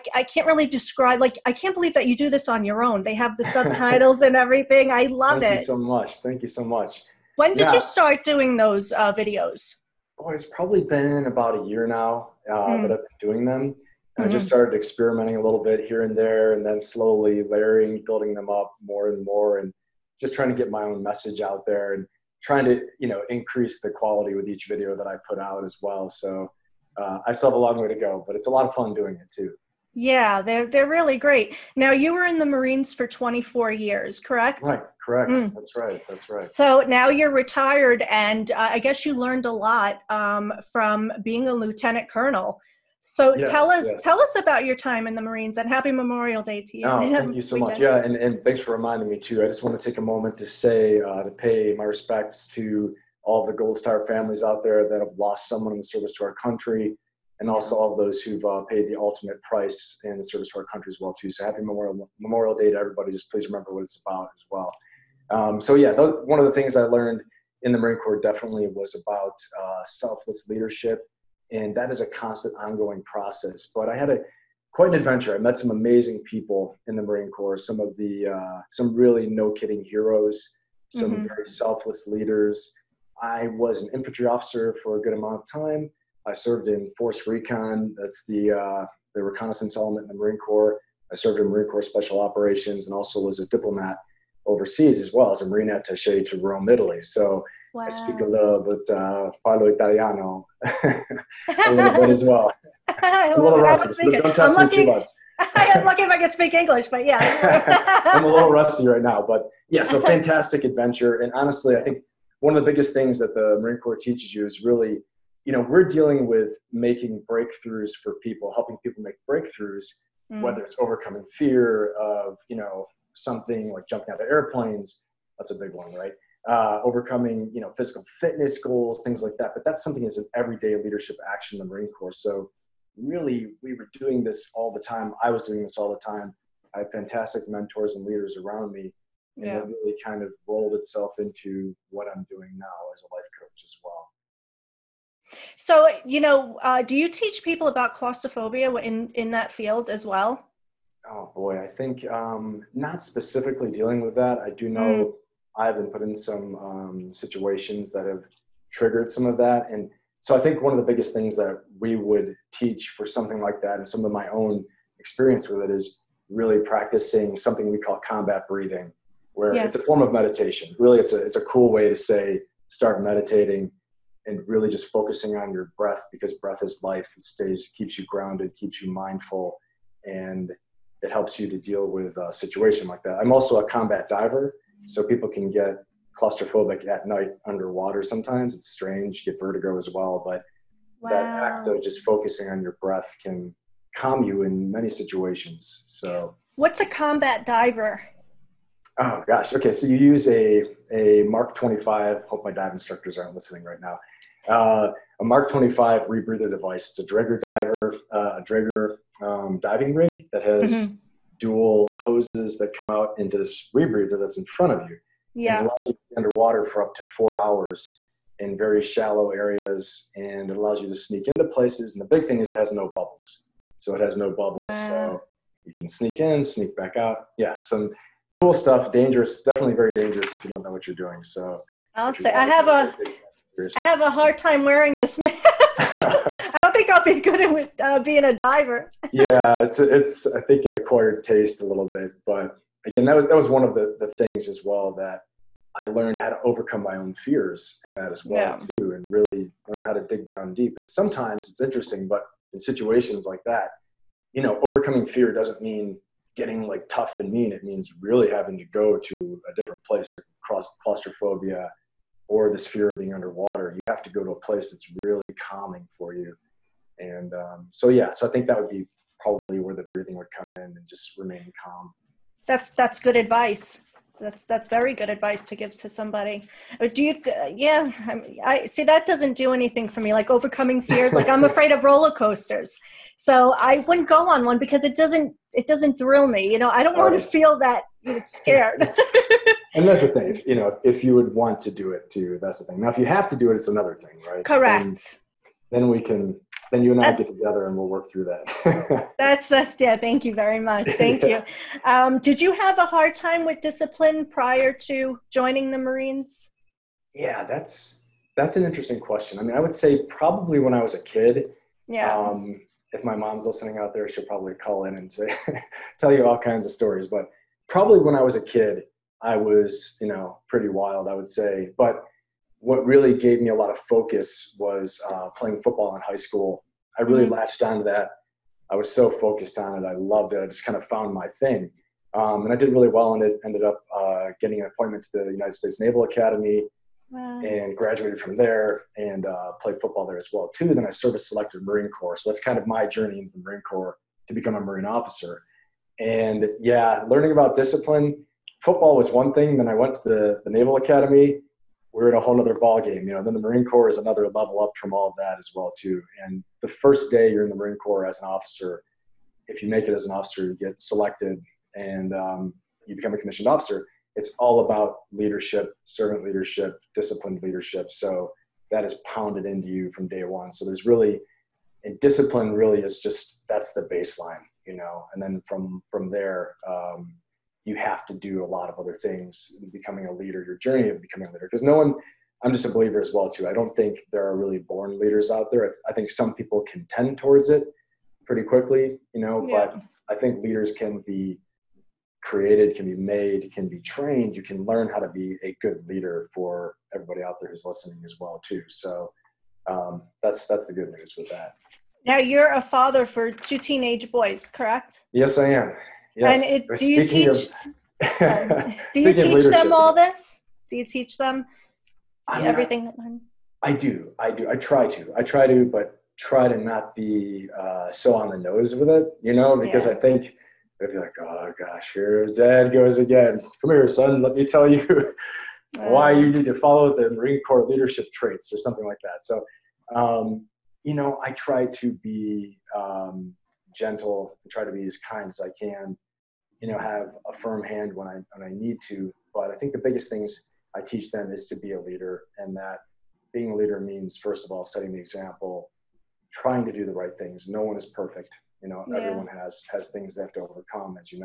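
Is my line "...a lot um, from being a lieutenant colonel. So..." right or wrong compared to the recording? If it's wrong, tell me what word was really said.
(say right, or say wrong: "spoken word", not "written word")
right.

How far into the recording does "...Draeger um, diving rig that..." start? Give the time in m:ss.
3:28.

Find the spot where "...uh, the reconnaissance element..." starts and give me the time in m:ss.
1:28.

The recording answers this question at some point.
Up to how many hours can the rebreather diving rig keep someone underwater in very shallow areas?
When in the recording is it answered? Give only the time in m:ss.
3:37.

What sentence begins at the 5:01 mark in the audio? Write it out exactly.
Um, did you have a hard time with discipline prior to joining the Marines?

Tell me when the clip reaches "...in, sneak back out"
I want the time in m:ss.
3:46.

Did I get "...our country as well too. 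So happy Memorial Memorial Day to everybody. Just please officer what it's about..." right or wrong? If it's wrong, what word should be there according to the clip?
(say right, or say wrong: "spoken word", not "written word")
wrong: "remember", not "officer".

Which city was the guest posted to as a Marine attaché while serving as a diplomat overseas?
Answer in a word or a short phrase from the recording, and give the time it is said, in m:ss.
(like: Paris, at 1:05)
Rome, at 1:36.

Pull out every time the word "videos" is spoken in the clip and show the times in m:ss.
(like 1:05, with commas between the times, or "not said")
0:09, 0:24.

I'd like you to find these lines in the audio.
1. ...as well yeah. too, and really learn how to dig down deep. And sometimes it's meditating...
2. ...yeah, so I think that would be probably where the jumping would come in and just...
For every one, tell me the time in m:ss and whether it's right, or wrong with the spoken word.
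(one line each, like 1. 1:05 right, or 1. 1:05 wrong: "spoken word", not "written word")
1. 4:08 wrong: "interesting", not "meditating"
2. 4:27 wrong: "breathing", not "jumping".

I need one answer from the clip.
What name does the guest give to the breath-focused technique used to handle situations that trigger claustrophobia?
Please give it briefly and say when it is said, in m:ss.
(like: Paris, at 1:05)
combat breathing, at 2:47.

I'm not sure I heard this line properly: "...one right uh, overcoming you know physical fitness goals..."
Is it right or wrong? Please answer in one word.
right.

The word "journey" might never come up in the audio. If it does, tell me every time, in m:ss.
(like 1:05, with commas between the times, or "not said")
5:42, 6:20.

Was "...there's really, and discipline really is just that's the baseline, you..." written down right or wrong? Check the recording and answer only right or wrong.
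right.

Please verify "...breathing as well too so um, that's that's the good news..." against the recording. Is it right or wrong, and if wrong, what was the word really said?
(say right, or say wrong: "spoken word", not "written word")
wrong: "listening", not "breathing".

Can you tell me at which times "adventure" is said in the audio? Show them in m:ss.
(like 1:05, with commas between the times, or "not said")
1:14, 1:50.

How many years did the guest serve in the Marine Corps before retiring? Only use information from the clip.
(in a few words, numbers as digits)
24.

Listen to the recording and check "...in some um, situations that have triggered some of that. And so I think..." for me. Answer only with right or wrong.
right.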